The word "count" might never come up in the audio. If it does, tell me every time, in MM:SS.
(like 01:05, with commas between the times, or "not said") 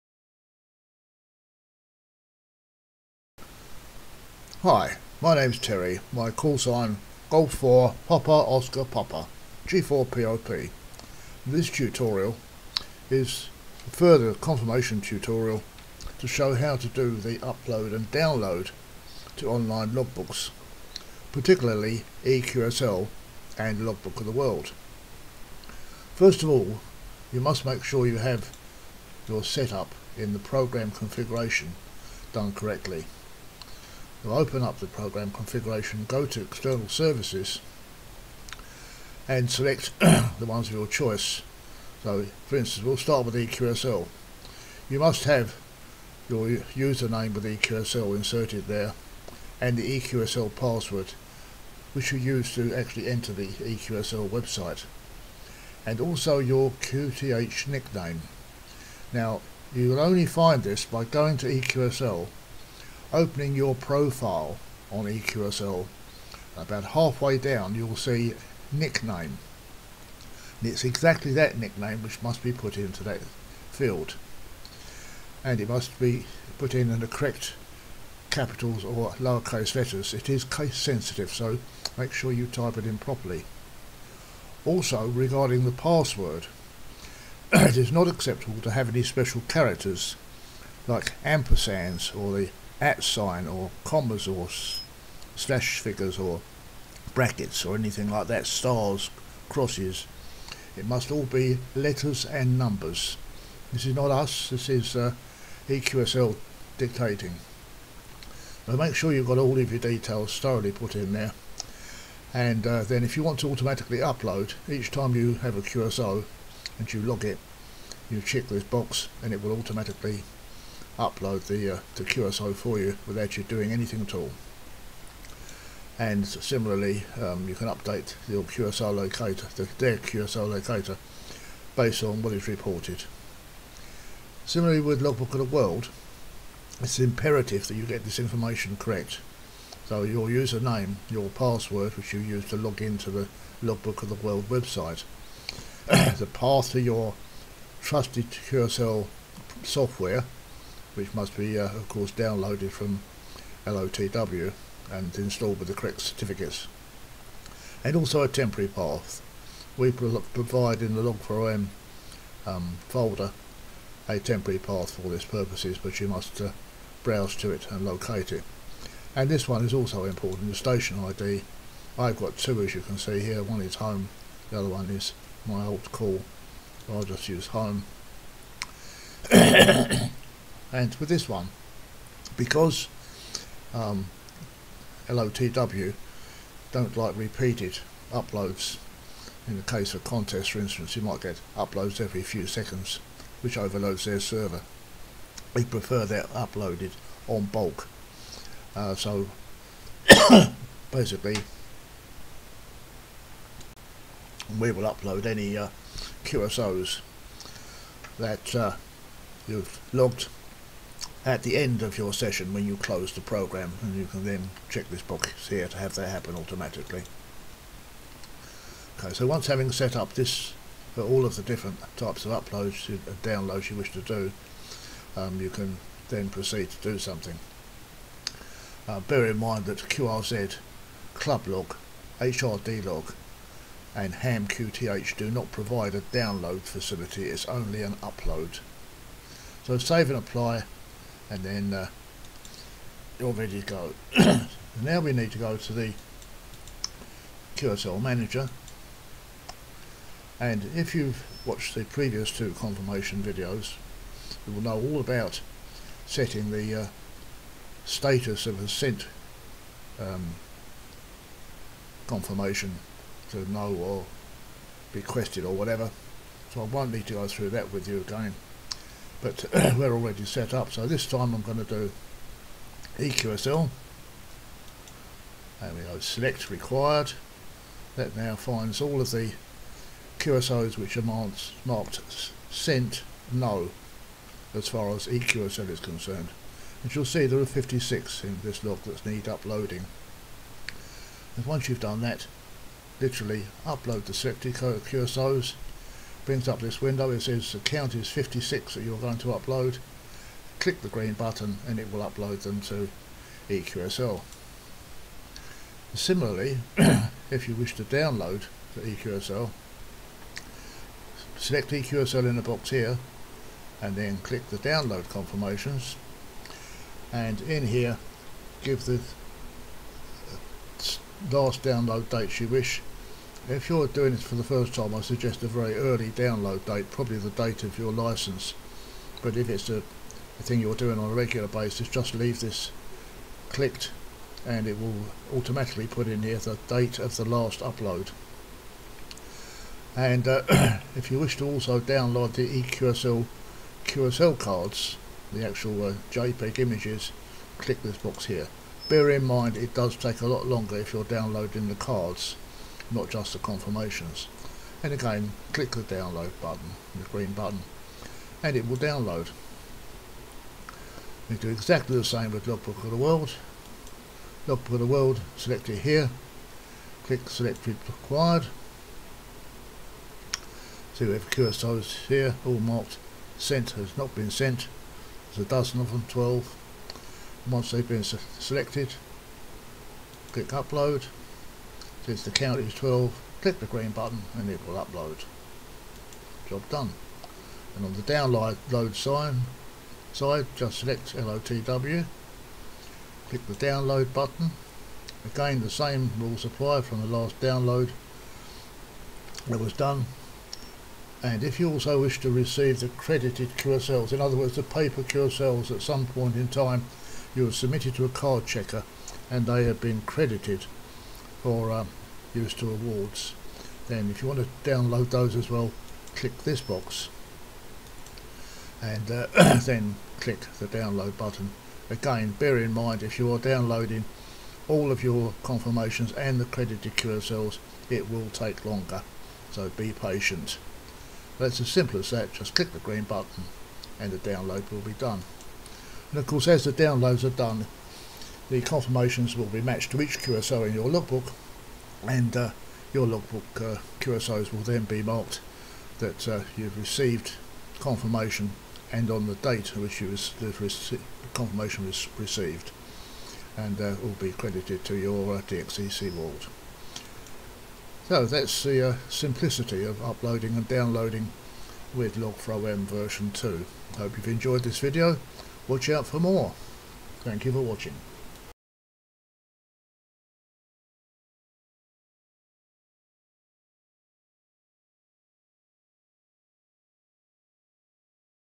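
04:57, 06:22.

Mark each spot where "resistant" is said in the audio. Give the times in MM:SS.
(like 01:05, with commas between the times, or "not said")
not said.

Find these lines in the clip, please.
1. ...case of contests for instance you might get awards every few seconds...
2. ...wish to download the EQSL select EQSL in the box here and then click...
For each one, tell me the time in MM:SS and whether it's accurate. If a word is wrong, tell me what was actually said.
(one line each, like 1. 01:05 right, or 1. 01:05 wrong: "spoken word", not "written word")
1. 03:09 wrong: "uploads", not "awards"
2. 05:07 right.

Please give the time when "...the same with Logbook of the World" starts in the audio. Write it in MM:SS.
06:01.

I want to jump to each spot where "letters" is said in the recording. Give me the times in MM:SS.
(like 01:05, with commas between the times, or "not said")
01:19, 01:41.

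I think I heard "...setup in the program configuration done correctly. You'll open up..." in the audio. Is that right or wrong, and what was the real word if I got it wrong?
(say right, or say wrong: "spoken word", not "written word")
right.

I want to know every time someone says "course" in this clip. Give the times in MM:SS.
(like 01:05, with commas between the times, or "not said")
02:31, 07:16.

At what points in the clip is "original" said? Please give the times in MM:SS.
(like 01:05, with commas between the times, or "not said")
not said.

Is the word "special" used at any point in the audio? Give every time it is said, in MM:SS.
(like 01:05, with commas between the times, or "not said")
01:29.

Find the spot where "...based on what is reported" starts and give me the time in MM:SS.
02:11.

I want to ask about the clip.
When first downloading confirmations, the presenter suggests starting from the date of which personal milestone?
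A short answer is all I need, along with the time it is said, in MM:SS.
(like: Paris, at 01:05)
date of your license, at 05:27.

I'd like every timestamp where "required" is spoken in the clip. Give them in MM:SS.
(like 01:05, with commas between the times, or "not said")
04:36, 06:07.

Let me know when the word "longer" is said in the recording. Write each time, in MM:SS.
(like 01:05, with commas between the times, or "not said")
05:50, 07:08.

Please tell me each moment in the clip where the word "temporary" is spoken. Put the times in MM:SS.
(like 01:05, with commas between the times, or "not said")
02:38, 02:44.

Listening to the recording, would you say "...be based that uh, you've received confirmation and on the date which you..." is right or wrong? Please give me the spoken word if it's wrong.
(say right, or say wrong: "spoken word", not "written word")
wrong: "marked", not "based".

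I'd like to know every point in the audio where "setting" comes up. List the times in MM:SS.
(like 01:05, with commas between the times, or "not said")
04:16.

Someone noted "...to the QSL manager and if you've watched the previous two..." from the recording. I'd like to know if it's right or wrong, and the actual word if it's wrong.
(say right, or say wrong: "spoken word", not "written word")
right.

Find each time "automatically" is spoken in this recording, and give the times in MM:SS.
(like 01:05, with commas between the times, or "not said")
01:53, 01:59, 03:36, 05:35.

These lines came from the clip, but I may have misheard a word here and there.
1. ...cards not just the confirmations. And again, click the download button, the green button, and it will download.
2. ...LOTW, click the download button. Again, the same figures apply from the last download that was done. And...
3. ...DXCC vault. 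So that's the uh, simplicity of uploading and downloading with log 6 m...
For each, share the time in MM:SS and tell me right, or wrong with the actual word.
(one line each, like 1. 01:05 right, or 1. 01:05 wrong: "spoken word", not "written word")
1. 05:51 right
2. 06:31 wrong: "rules", not "figures"
3. 07:35 wrong: "4", not "6".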